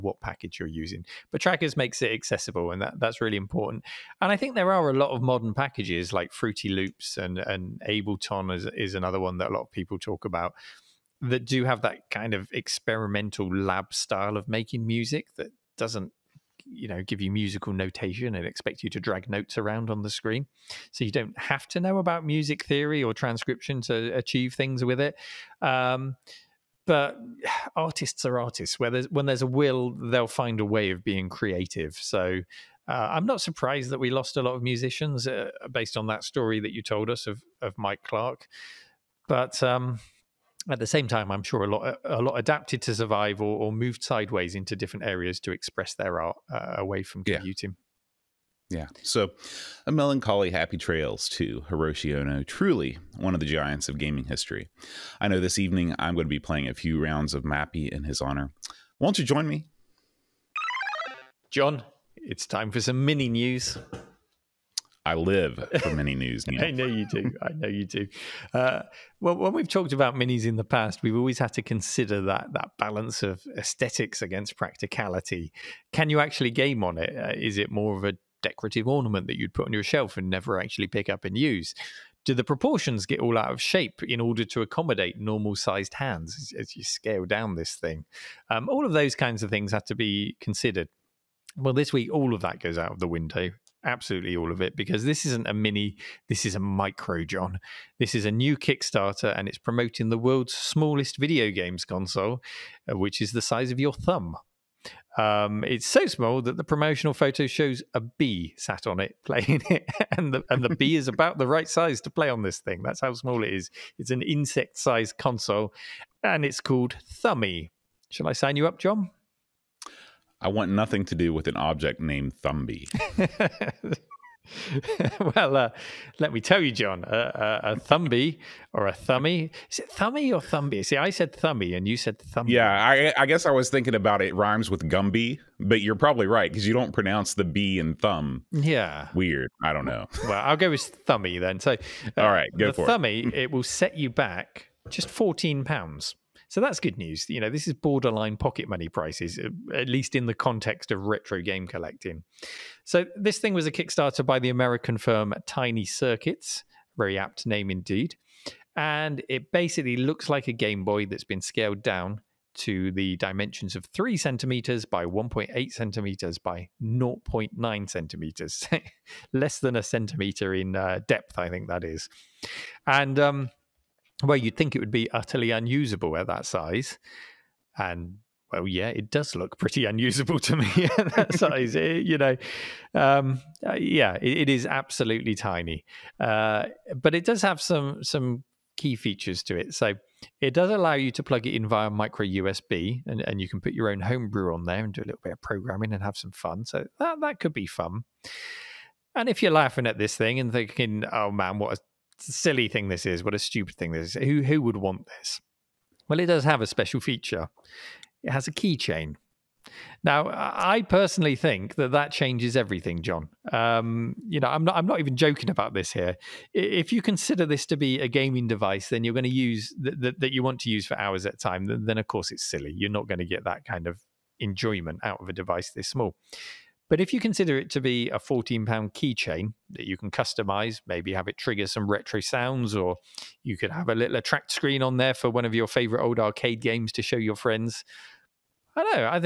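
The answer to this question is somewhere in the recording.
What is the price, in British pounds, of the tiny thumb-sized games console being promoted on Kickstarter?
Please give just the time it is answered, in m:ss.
2:25.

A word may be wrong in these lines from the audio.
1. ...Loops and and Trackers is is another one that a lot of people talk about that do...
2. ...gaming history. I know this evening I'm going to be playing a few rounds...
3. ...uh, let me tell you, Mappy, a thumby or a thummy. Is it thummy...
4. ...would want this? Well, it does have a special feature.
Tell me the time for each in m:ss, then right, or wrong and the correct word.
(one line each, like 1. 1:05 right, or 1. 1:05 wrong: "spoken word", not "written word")
1. 0:06 wrong: "Ableton", not "Trackers"
2. 0:53 right
3. 2:05 wrong: "John", not "Mappy"
4. 3:24 right.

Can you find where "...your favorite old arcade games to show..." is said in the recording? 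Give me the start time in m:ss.
3:55.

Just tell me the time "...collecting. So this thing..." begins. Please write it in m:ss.
2:31.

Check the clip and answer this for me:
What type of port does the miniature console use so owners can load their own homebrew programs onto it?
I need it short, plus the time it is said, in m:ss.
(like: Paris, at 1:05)
micro USB, at 3:11.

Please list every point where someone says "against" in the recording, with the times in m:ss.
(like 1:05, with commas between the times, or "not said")
1:14.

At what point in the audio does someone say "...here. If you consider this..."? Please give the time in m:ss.
3:35.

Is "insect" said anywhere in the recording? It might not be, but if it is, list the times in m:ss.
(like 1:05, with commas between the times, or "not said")
1:54.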